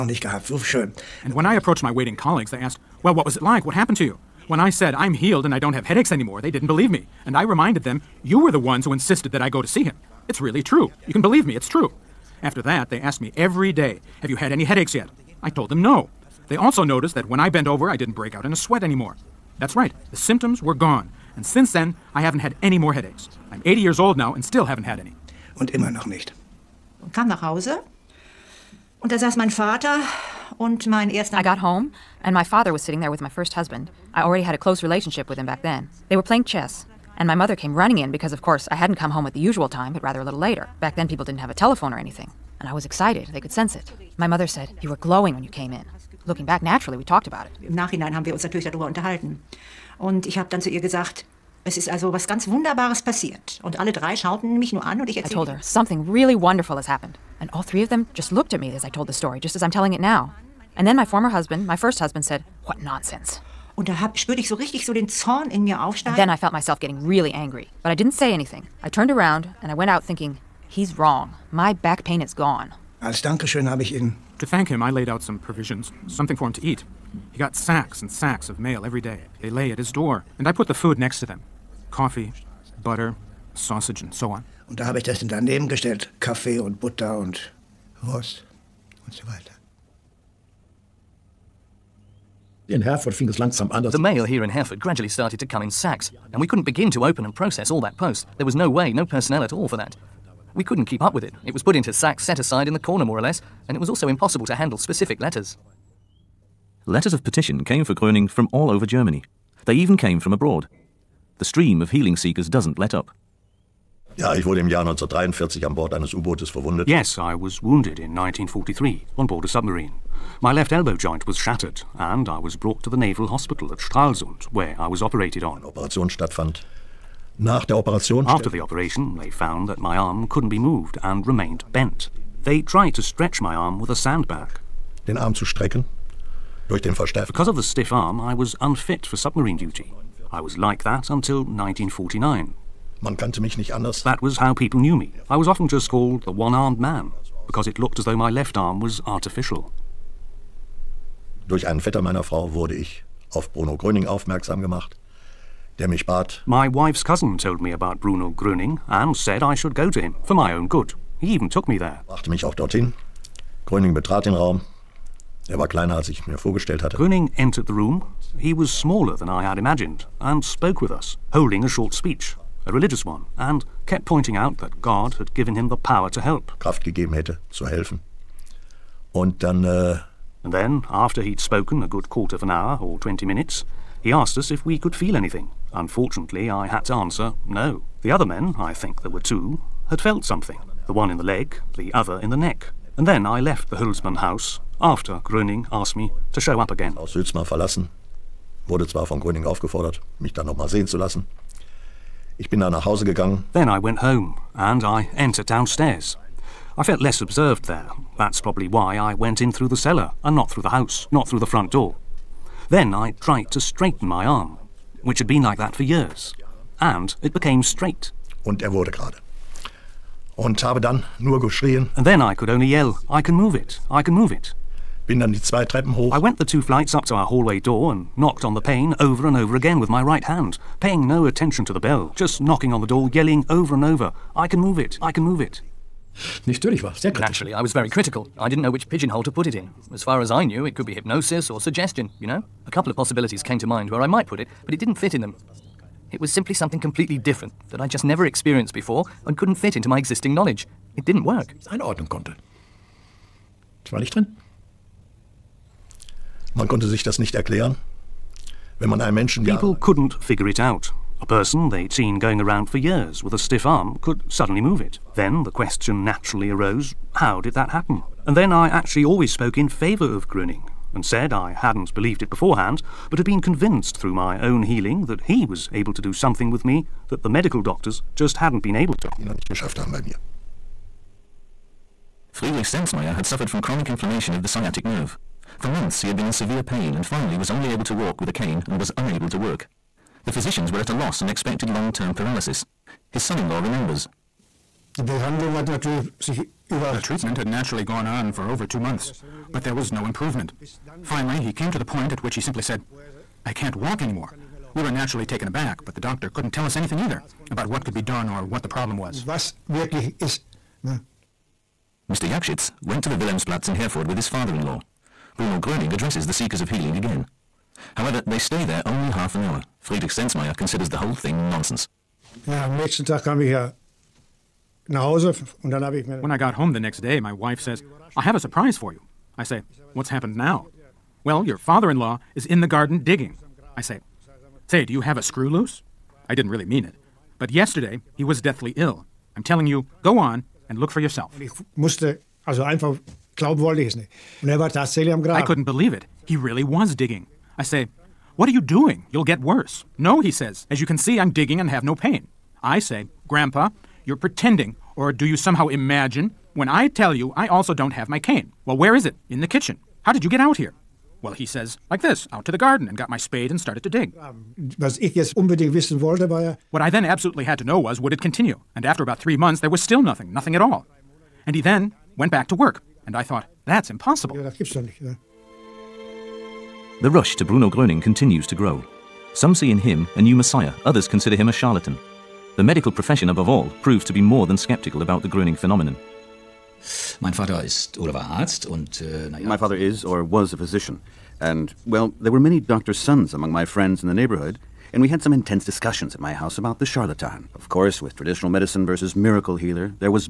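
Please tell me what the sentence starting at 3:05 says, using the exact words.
Unfortunately, I had to answer no.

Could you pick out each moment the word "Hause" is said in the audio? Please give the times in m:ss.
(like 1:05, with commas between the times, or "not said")
0:27, 3:22.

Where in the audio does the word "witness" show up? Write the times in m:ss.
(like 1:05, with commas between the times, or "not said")
not said.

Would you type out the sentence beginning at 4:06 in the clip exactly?
It was simply something completely different that I just never experienced before and couldn't fit into my existing knowledge.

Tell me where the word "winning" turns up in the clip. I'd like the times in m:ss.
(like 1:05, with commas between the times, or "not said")
not said.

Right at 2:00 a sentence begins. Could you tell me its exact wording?
My left elbow joint was shattered, and I was brought to the Naval Hospital at Stralsund, where I was operated on.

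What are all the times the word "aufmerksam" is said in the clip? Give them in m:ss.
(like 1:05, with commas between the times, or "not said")
2:34.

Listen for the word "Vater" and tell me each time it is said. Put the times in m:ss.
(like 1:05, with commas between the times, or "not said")
0:29, 6:27.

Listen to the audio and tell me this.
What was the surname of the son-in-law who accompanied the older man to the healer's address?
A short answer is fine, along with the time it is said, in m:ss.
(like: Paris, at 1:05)
Jakschitz, at 5:12.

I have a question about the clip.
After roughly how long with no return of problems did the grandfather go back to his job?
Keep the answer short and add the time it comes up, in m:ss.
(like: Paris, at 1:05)
3 months, at 6:09.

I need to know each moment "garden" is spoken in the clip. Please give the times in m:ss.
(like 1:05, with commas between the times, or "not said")
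5:32, 6:02.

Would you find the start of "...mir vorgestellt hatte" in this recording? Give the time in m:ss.
2:46.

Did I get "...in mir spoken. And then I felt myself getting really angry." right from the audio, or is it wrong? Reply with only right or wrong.
wrong.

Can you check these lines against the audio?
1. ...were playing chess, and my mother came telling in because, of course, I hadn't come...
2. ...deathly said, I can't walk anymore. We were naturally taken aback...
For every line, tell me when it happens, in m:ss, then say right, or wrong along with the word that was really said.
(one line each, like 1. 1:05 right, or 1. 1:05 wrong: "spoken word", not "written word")
1. 0:36 wrong: "running", not "telling"
2. 5:02 wrong: "simply", not "deathly".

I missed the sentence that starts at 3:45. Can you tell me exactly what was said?
Bin dann die zwei Treppen hoch.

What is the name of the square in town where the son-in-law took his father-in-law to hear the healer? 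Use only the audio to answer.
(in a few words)
Wilhelmsplatz.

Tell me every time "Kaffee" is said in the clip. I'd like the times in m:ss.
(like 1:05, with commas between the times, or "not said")
1:26.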